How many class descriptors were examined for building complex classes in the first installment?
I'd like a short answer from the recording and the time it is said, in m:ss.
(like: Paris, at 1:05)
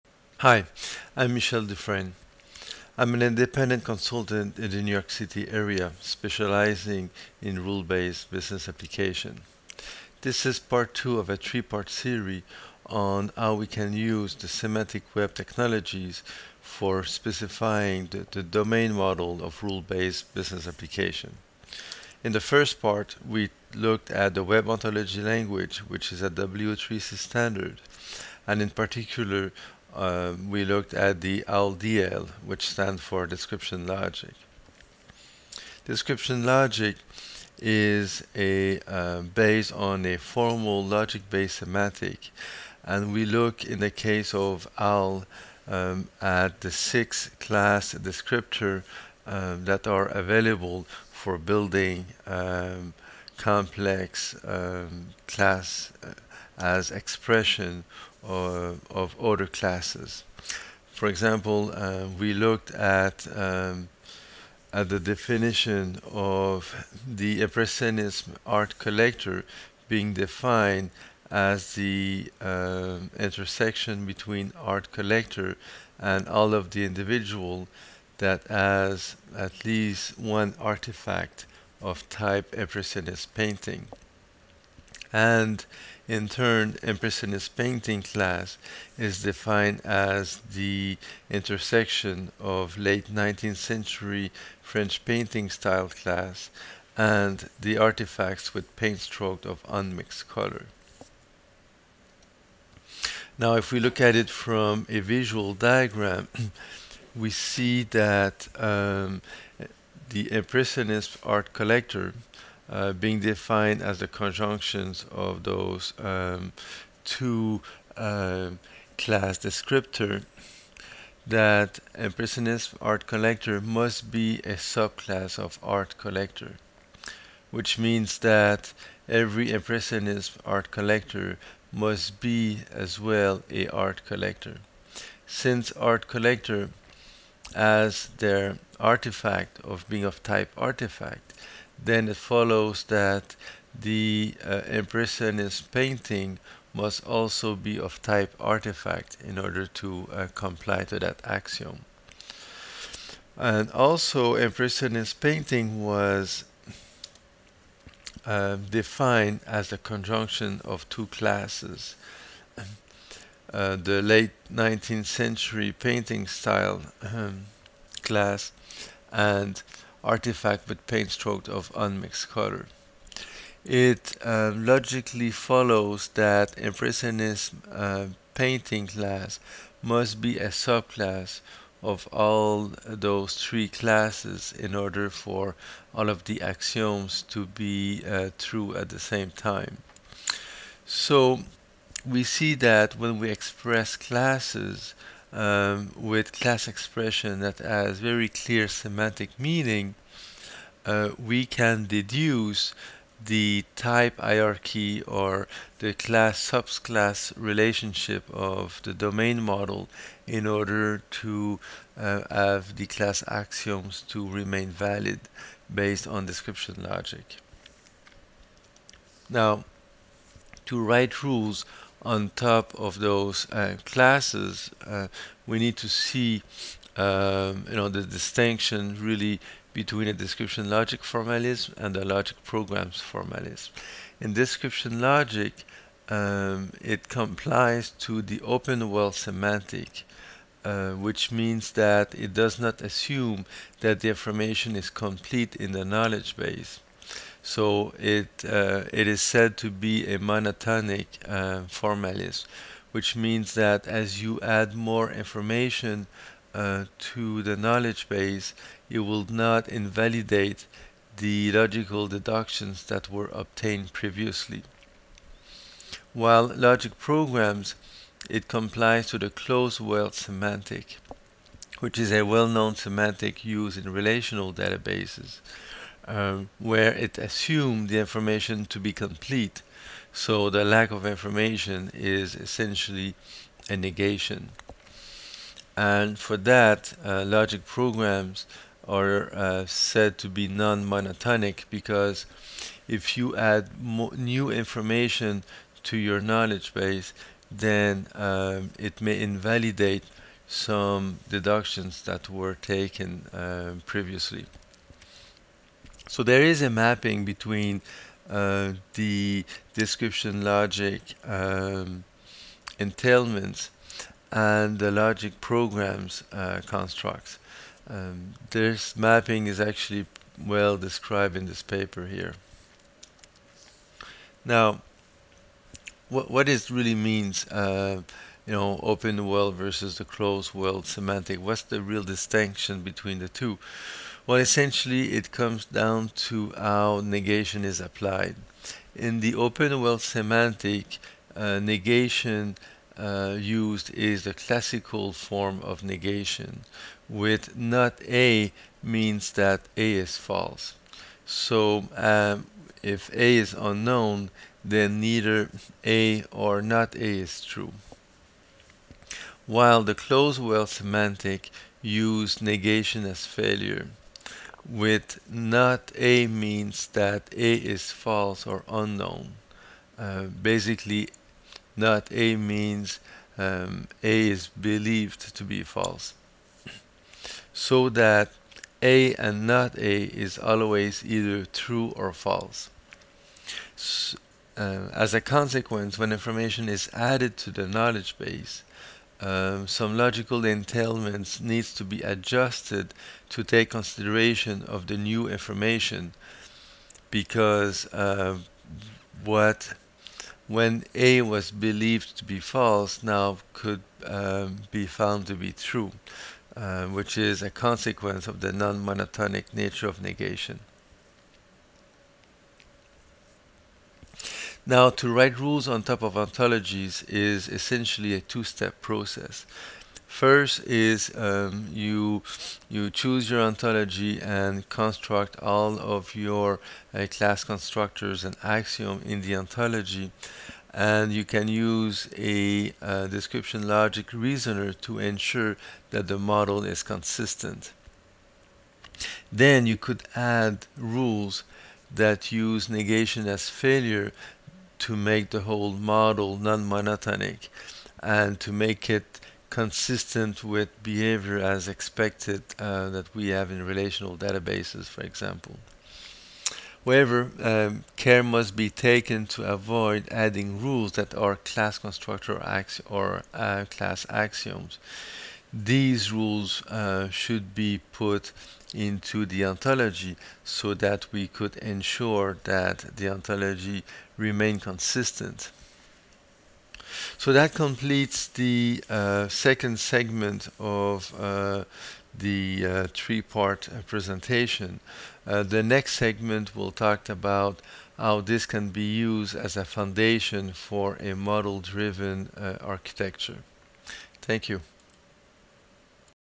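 6, at 0:46.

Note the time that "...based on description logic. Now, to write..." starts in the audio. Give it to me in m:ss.
3:35.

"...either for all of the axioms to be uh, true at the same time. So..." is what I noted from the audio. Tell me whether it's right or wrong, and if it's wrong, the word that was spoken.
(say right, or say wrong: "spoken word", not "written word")
wrong: "order", not "either".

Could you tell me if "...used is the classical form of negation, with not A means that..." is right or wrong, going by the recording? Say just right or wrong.
right.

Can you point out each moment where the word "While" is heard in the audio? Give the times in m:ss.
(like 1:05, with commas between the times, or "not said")
4:26, 5:59.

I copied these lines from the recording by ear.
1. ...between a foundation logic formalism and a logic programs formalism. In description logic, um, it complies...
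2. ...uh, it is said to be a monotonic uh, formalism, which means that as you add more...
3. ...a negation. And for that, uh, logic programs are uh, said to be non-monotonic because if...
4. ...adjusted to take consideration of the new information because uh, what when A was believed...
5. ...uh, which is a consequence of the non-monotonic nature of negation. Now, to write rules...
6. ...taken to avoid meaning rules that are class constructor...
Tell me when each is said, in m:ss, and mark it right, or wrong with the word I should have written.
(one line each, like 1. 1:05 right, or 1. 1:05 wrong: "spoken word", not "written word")
1. 3:49 wrong: "description", not "foundation"
2. 4:08 right
3. 4:43 right
4. 6:32 right
5. 6:46 right
6. 7:38 wrong: "adding", not "meaning".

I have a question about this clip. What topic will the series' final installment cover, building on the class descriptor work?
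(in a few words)
model-driven architecture.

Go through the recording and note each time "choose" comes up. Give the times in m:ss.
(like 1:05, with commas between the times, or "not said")
7:02.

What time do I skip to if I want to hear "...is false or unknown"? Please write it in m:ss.
6:07.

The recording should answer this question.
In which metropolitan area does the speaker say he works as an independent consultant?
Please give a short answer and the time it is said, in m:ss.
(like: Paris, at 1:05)
New York City, at 0:04.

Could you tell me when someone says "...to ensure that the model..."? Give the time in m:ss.
7:14.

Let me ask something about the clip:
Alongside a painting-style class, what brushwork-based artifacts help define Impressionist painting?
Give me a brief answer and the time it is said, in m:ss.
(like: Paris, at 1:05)
paint strokes of unmixed color, at 1:38.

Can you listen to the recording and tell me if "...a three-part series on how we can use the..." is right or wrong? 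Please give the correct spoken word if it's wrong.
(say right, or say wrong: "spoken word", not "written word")
right.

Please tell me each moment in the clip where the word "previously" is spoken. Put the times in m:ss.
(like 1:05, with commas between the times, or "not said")
4:23, 5:03.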